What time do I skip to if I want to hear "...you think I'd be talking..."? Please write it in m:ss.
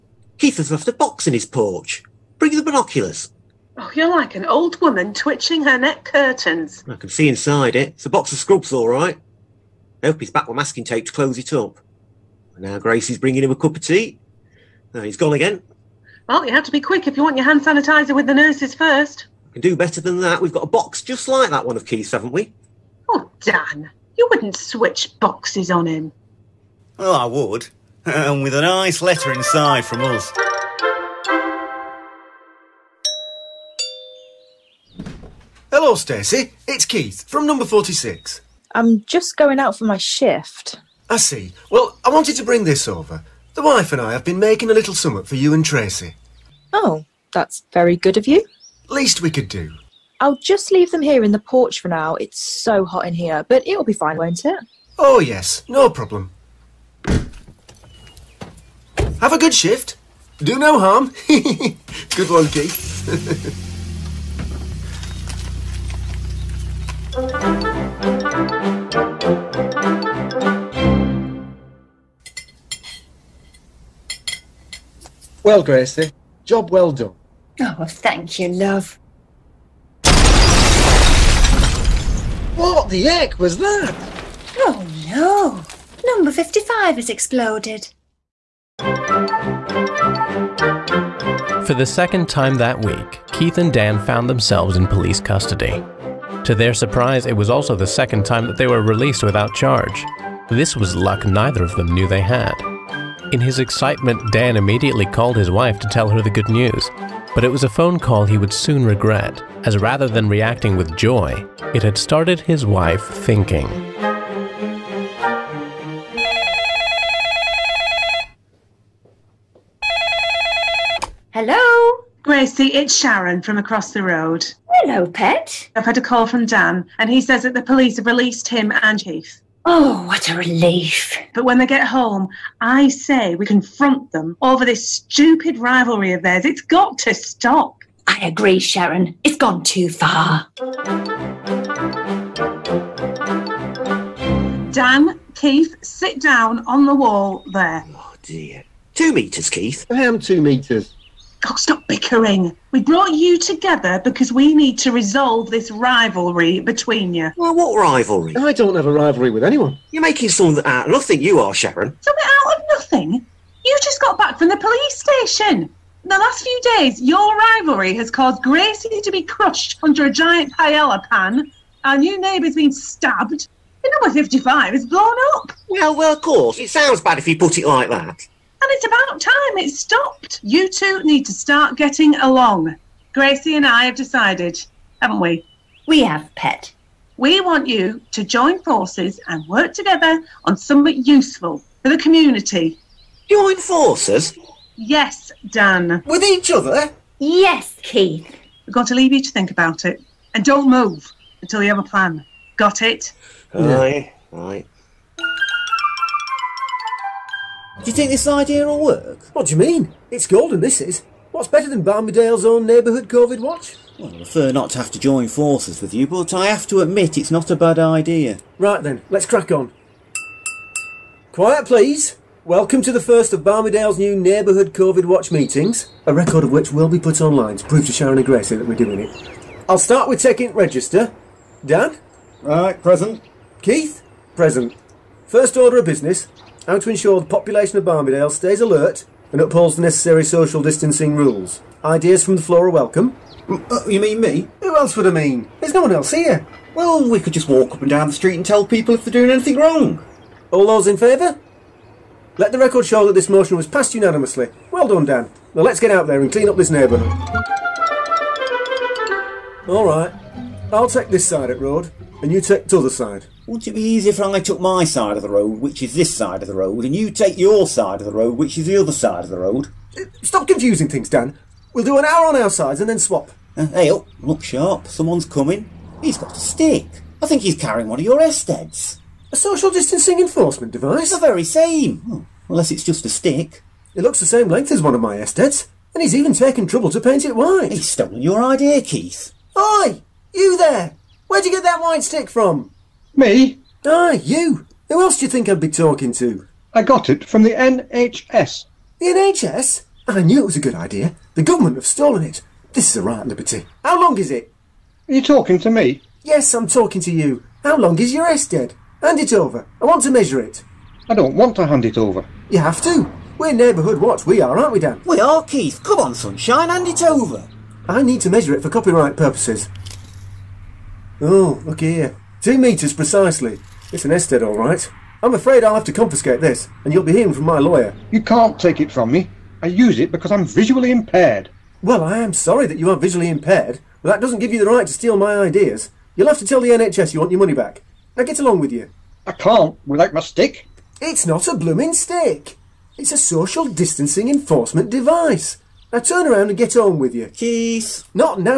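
4:55.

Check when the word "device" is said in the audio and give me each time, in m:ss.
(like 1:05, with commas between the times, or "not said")
4:40, 5:44.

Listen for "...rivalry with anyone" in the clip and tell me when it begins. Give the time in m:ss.
2:38.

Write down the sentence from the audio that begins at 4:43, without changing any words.
It looks the same length as one of my SDEDs, and he's even taken trouble to paint it white.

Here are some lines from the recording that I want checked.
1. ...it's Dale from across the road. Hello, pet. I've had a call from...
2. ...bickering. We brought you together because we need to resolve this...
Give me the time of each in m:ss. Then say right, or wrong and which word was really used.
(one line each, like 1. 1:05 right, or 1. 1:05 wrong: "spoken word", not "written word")
1. 2:02 wrong: "Sharon", not "Dale"
2. 2:31 right.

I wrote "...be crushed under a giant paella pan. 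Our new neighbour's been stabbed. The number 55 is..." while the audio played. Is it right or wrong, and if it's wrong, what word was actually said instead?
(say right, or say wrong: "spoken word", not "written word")
right.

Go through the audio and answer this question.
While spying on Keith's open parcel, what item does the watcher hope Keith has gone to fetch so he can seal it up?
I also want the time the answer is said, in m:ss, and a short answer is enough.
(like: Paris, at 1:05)
Masking tape, at 0:10.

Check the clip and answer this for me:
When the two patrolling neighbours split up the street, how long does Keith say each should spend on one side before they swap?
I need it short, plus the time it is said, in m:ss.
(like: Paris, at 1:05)
An hour, at 4:31.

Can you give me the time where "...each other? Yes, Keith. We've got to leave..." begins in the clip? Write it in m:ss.
3:16.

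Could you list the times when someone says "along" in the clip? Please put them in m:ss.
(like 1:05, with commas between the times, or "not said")
3:02, 5:38.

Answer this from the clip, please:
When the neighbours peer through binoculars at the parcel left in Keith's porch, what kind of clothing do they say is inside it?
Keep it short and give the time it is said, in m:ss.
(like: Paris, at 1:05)
Scrubs, at 0:08.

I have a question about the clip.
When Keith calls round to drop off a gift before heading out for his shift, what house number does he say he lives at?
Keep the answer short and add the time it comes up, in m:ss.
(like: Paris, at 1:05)
46, at 0:37.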